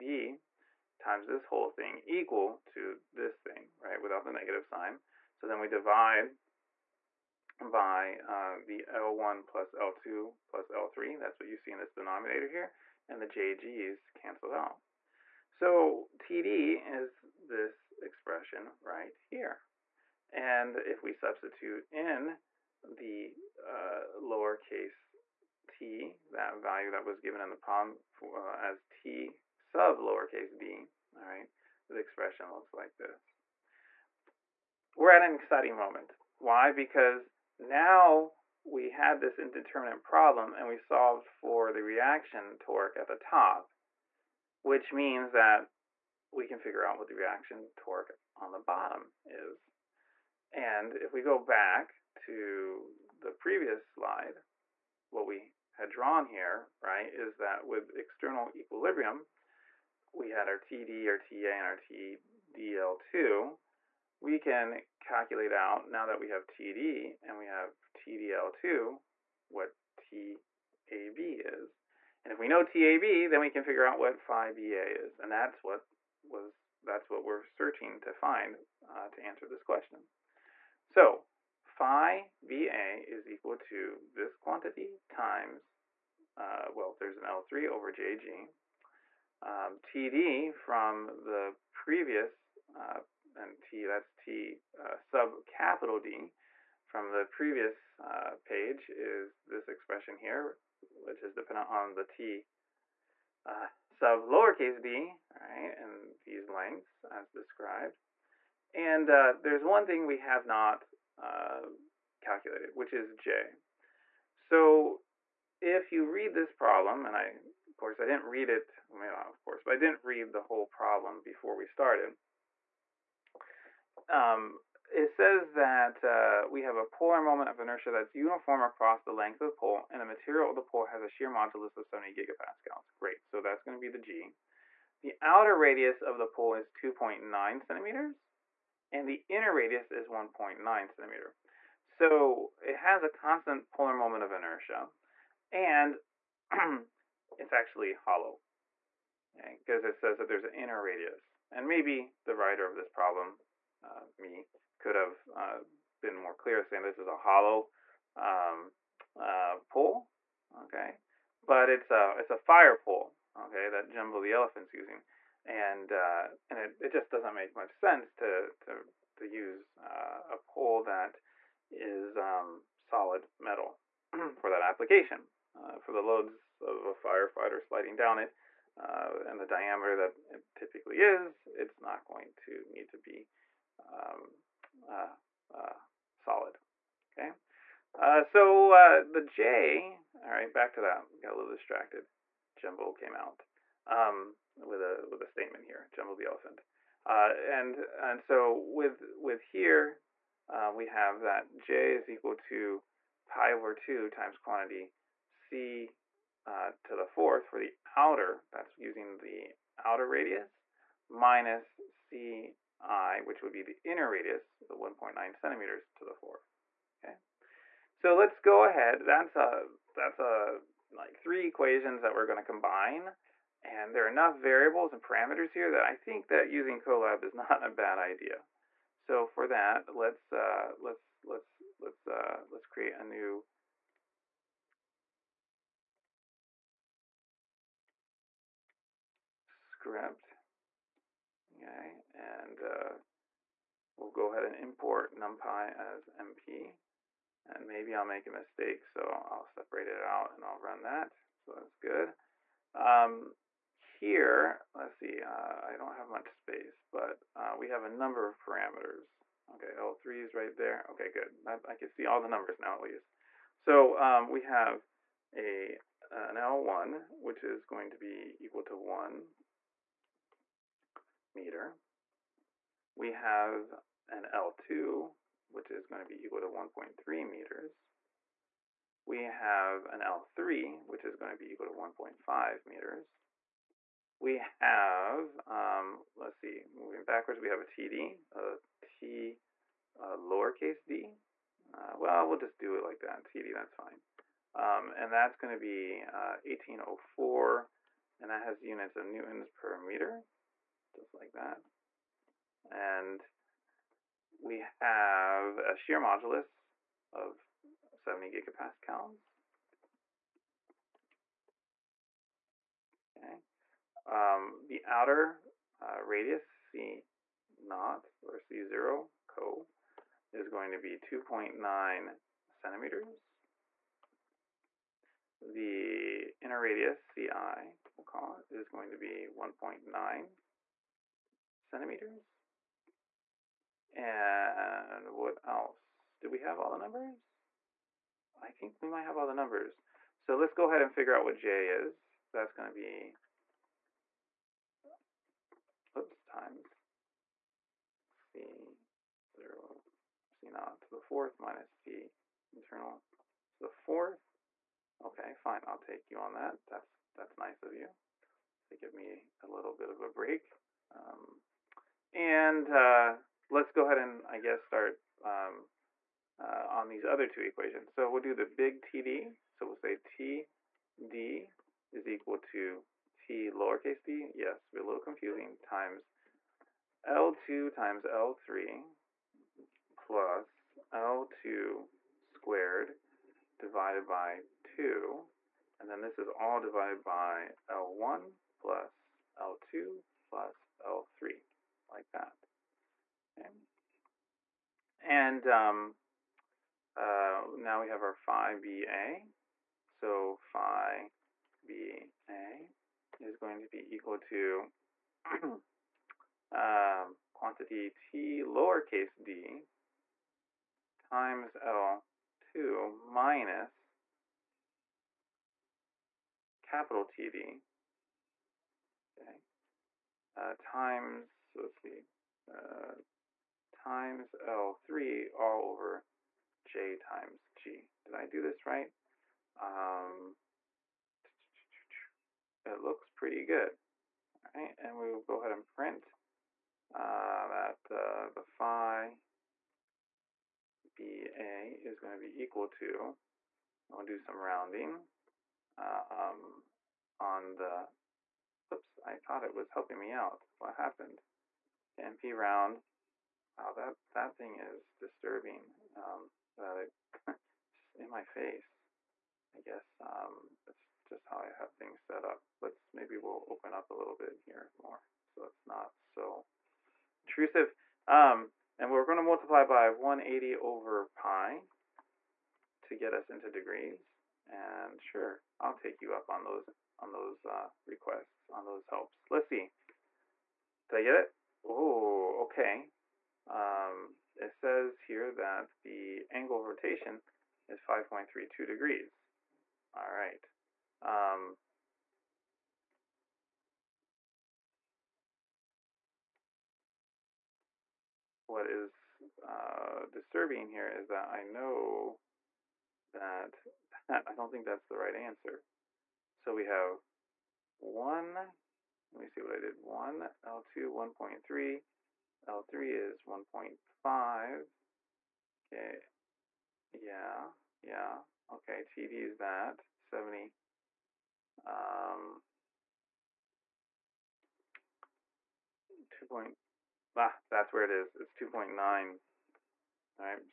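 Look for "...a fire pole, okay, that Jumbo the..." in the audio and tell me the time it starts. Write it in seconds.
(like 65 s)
162 s.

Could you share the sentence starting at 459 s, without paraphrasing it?
I guess um, that's just how I have things set up.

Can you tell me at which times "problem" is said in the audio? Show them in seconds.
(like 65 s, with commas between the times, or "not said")
27 s, 40 s, 116 s, 120 s, 152 s.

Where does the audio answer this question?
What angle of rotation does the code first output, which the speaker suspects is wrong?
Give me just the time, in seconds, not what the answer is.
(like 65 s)
487 s.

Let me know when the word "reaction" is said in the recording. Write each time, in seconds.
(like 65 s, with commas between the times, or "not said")
41 s, 47 s.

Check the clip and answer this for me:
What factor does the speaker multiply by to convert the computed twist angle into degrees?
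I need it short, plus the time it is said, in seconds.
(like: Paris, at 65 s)
180 over pi, at 469 s.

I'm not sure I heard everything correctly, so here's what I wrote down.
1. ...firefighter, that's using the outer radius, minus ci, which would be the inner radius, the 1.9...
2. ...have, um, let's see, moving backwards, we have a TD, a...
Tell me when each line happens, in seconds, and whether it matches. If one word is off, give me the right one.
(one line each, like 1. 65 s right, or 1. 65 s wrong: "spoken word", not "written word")
1. 207 s wrong: "outer", not "firefighter"
2. 284 s right.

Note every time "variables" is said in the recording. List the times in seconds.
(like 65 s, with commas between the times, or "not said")
224 s.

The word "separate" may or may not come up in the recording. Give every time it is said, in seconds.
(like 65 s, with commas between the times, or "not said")
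249 s.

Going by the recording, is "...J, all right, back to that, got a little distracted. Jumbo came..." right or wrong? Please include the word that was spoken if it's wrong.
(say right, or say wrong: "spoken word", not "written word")
right.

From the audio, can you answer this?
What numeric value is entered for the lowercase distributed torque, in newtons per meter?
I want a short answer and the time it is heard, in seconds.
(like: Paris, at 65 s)
1804, at 296 s.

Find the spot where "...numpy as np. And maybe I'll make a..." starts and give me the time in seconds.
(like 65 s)
245 s.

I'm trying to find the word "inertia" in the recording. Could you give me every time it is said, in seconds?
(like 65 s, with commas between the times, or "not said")
127 s, 144 s.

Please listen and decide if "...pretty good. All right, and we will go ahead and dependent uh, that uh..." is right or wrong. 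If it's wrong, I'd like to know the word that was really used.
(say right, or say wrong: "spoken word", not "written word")
wrong: "print", not "dependent".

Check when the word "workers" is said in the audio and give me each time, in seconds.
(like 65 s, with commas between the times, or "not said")
not said.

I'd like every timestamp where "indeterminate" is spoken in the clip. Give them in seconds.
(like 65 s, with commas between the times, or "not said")
39 s.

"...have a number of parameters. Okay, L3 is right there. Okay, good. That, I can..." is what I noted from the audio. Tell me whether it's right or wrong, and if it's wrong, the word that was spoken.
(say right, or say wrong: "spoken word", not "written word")
right.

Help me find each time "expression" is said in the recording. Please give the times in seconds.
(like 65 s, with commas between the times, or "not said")
18 s, 31 s, 99 s.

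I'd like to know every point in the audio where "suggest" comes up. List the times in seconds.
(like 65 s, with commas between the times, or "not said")
not said.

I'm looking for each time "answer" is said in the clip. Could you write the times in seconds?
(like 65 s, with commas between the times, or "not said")
79 s, 505 s.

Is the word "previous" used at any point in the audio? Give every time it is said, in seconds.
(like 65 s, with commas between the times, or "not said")
53 s, 91 s, 97 s.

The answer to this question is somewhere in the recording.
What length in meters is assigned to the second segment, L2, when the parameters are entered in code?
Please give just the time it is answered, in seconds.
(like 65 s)
276 s.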